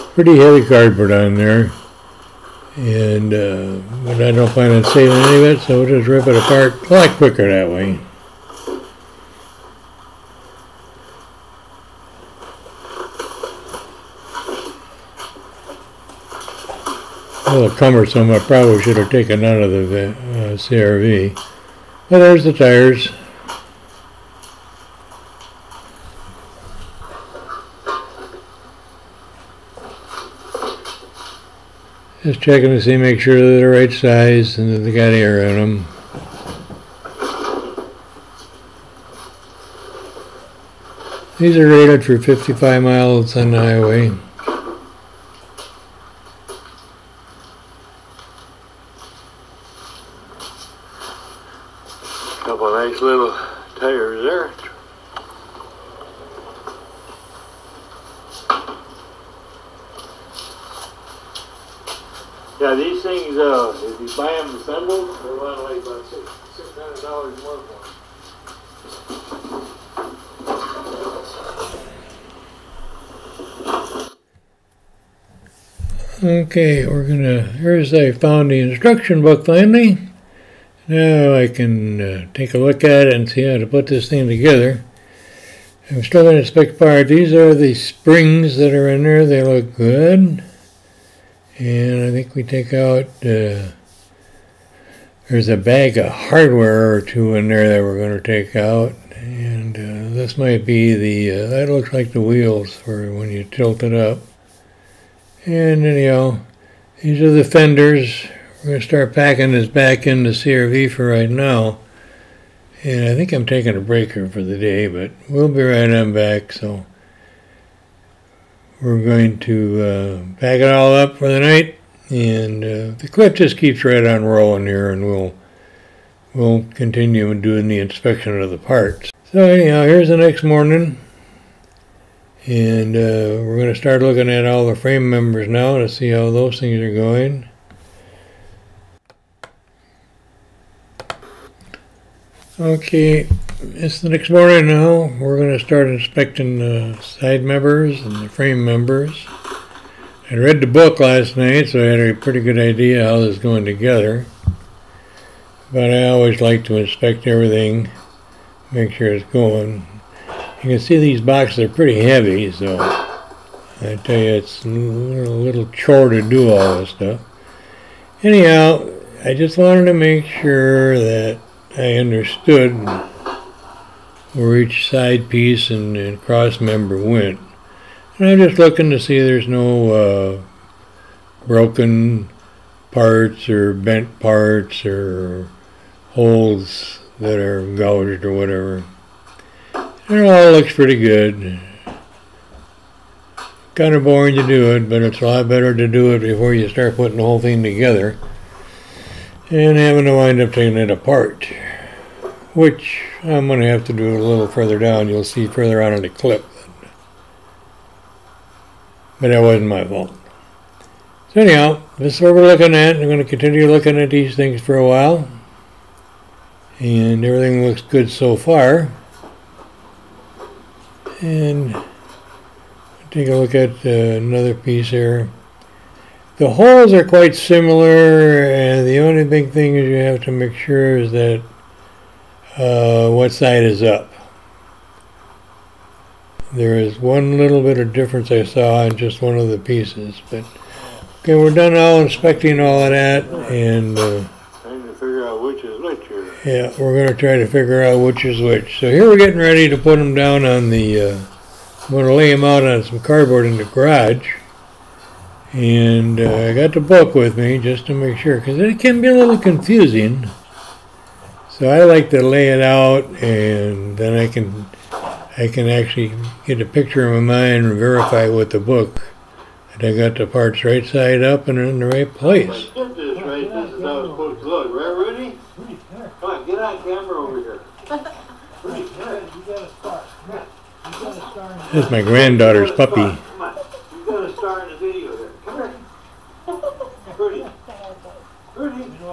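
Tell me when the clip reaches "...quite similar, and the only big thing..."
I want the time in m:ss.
3:47.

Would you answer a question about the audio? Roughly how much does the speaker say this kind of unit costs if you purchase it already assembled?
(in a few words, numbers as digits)
$600.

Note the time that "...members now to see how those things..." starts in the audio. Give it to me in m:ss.
2:15.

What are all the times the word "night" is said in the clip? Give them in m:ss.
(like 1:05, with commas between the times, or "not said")
2:01, 2:31.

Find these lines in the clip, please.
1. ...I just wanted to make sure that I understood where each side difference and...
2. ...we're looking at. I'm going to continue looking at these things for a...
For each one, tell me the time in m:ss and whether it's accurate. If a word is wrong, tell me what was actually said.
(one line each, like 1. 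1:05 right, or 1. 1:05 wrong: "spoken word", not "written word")
1. 2:49 wrong: "piece", not "difference"
2. 3:32 right.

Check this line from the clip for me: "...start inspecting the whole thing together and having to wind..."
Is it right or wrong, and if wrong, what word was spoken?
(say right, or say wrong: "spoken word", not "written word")
wrong: "putting", not "inspecting".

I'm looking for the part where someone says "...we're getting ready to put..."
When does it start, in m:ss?
4:09.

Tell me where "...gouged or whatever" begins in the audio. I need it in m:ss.
3:07.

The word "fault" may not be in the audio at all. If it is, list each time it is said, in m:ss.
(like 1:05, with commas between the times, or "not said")
3:29.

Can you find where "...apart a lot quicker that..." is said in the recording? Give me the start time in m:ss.
0:06.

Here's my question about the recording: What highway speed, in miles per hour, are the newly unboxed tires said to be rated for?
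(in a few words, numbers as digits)
55.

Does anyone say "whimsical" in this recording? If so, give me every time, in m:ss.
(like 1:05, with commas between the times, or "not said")
not said.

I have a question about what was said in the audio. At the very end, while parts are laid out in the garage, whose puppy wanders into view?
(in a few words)
granddaughter's.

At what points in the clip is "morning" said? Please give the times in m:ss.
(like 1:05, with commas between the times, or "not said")
2:10, 2:24.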